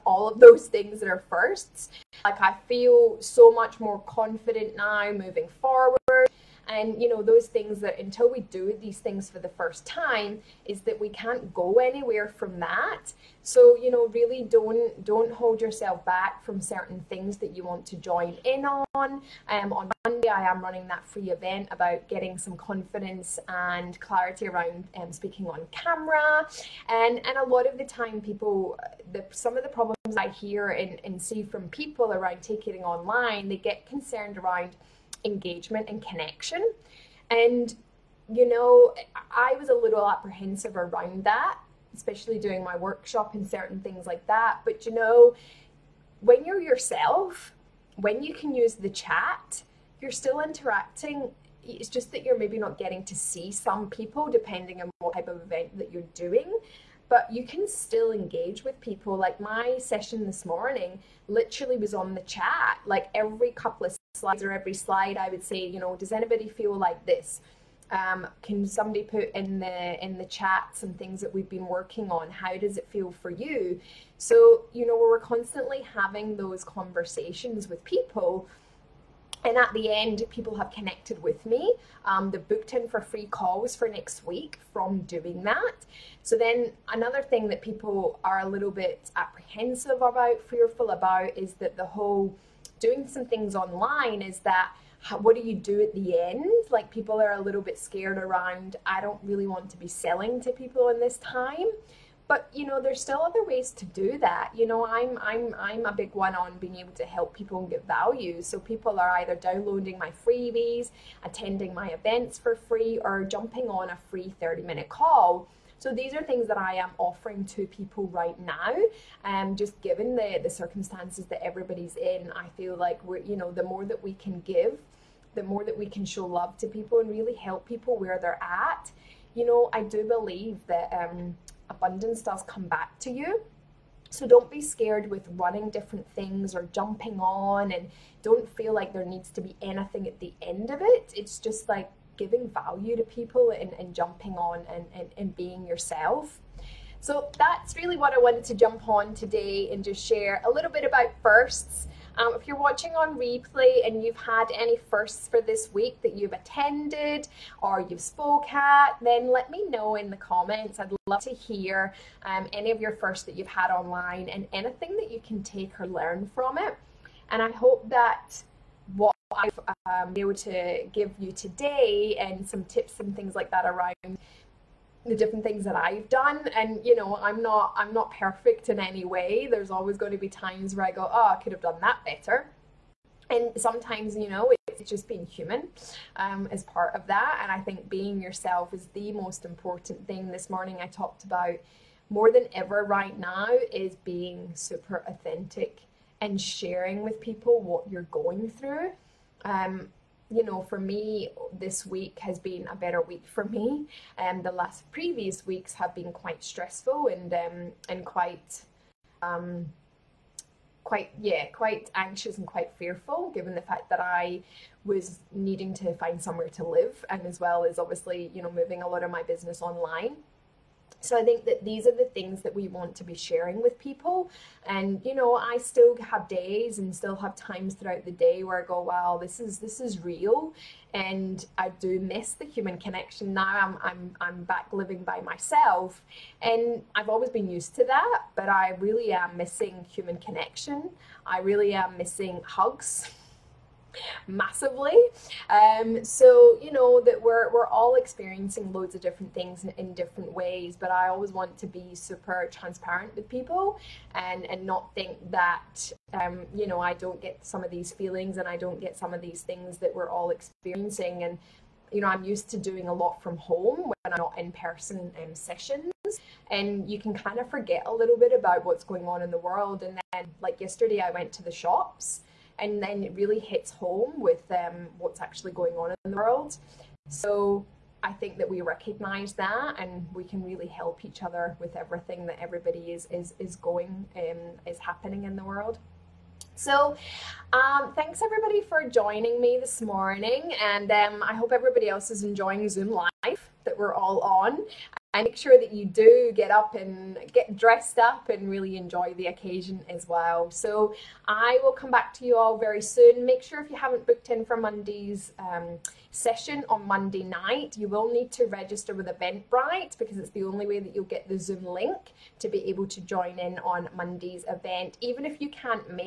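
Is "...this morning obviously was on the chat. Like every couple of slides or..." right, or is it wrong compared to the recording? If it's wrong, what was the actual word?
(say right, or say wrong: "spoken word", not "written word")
wrong: "literally", not "obviously".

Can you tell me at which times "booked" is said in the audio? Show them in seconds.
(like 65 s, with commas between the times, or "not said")
82 s, 304 s.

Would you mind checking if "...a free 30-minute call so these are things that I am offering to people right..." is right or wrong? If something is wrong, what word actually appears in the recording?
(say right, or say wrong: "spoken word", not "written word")
right.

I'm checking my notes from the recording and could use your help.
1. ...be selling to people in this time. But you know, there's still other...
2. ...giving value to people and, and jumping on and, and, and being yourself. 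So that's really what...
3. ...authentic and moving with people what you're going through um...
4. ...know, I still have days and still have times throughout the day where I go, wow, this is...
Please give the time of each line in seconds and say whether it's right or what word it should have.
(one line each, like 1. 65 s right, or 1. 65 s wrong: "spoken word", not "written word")
1. 99 s right
2. 142 s right
3. 195 s wrong: "sharing", not "moving"
4. 225 s right.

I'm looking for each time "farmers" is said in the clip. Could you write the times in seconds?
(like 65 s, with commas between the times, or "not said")
not said.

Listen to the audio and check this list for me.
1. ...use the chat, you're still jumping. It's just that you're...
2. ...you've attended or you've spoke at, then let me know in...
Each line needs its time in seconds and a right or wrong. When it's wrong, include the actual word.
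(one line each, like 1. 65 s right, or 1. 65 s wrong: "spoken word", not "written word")
1. 48 s wrong: "interacting", not "jumping"
2. 156 s right.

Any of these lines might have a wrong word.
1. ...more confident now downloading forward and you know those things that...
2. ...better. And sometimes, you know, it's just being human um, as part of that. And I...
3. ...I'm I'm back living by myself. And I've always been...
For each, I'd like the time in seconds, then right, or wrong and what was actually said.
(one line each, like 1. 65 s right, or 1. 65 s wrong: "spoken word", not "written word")
1. 3 s wrong: "moving", not "downloading"
2. 182 s right
3. 233 s right.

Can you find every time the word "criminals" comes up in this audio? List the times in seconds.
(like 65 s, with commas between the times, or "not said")
not said.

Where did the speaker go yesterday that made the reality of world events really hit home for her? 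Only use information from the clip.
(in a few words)
The shops.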